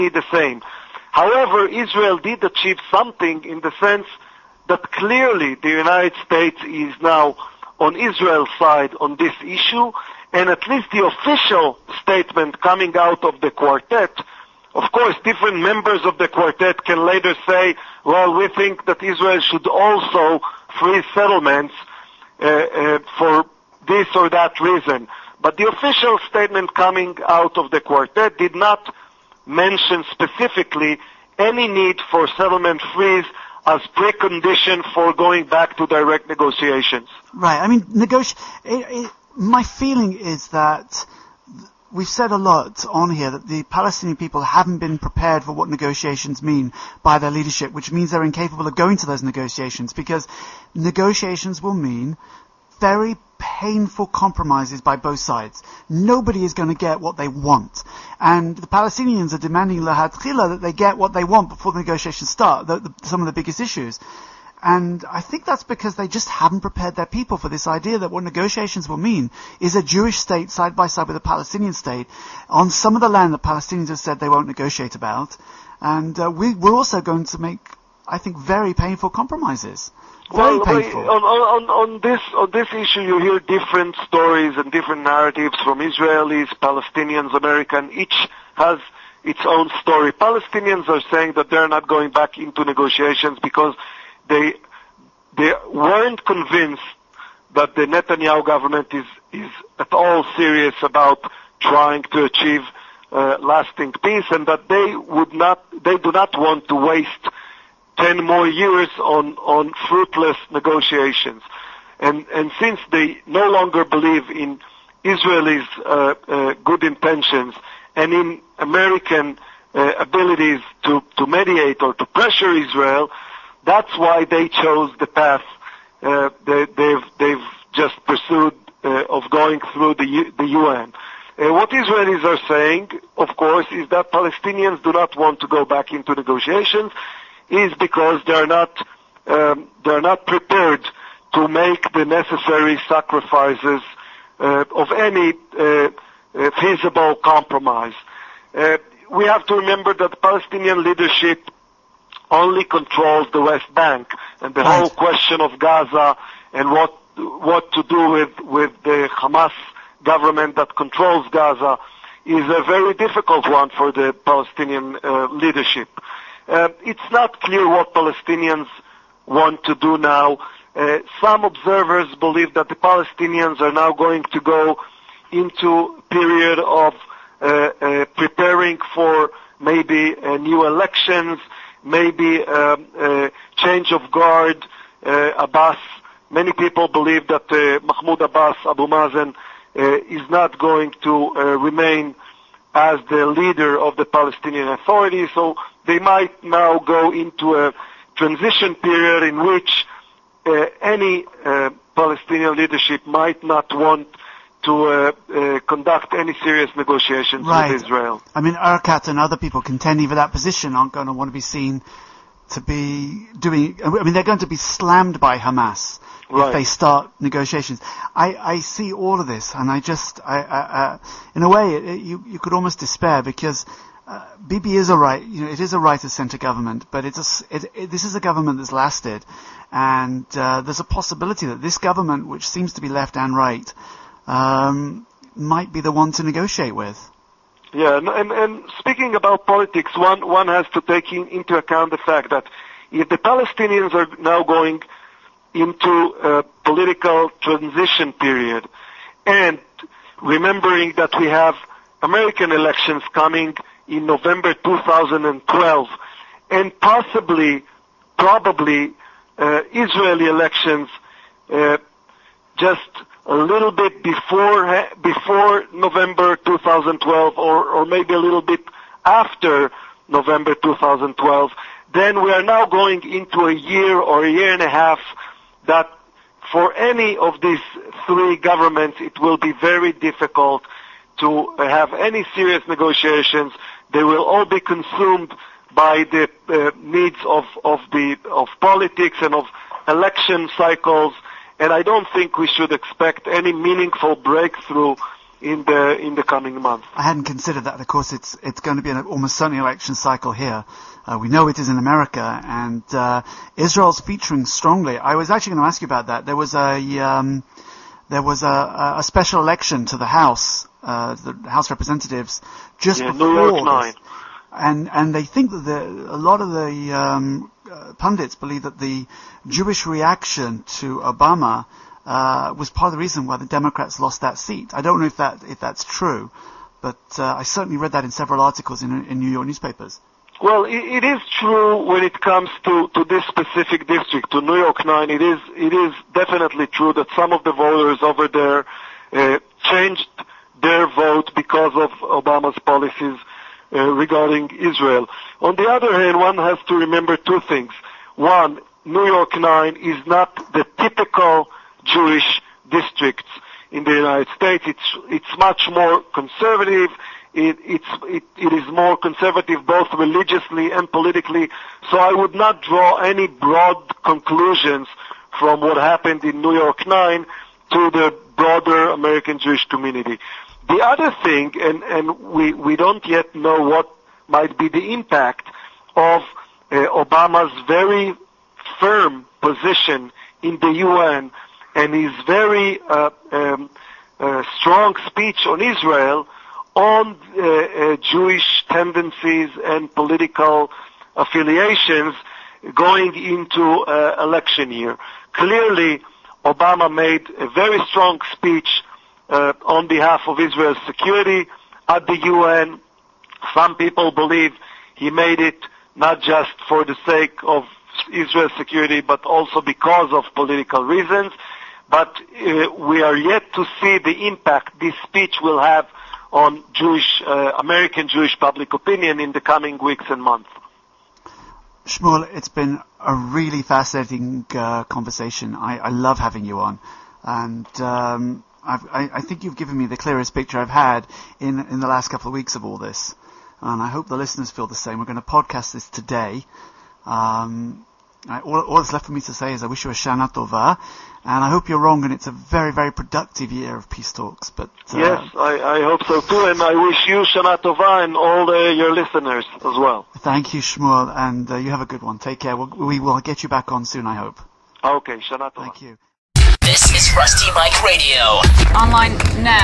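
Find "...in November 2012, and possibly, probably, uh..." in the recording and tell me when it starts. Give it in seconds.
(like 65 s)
253 s.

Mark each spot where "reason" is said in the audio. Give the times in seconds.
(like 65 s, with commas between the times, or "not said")
24 s, 322 s, 410 s.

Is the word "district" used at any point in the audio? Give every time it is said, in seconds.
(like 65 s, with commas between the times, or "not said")
333 s, 352 s.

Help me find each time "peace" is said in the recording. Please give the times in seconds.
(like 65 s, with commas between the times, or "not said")
104 s, 443 s.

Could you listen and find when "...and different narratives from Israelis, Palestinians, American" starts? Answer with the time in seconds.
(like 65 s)
84 s.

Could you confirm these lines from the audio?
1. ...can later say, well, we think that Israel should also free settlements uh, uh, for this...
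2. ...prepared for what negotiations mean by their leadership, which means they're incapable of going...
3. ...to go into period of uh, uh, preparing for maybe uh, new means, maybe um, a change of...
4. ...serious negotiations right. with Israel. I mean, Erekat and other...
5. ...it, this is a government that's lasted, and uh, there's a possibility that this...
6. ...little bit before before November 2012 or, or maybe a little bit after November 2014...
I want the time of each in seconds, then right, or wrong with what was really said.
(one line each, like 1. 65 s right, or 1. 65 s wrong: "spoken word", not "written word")
1. 16 s right
2. 44 s right
3. 174 s wrong: "elections", not "means"
4. 206 s right
5. 227 s right
6. 263 s wrong: "2012", not "2014".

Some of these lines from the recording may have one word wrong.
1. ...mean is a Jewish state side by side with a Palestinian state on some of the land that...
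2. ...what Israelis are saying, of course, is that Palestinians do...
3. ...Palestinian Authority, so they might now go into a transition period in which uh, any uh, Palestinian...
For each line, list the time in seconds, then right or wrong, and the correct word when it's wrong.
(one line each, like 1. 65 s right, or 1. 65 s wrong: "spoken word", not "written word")
1. 68 s right
2. 131 s right
3. 194 s right.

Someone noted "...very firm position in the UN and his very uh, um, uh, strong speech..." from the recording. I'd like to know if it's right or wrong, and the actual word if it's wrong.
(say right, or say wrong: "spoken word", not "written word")
right.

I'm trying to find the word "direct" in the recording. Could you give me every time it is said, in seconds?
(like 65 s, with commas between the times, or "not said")
35 s.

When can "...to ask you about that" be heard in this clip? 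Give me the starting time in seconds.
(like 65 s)
305 s.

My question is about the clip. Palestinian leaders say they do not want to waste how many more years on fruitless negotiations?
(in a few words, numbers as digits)
10.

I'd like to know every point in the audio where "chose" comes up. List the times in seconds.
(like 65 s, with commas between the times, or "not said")
124 s.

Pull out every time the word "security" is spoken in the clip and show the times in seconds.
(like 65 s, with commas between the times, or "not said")
400 s, 408 s.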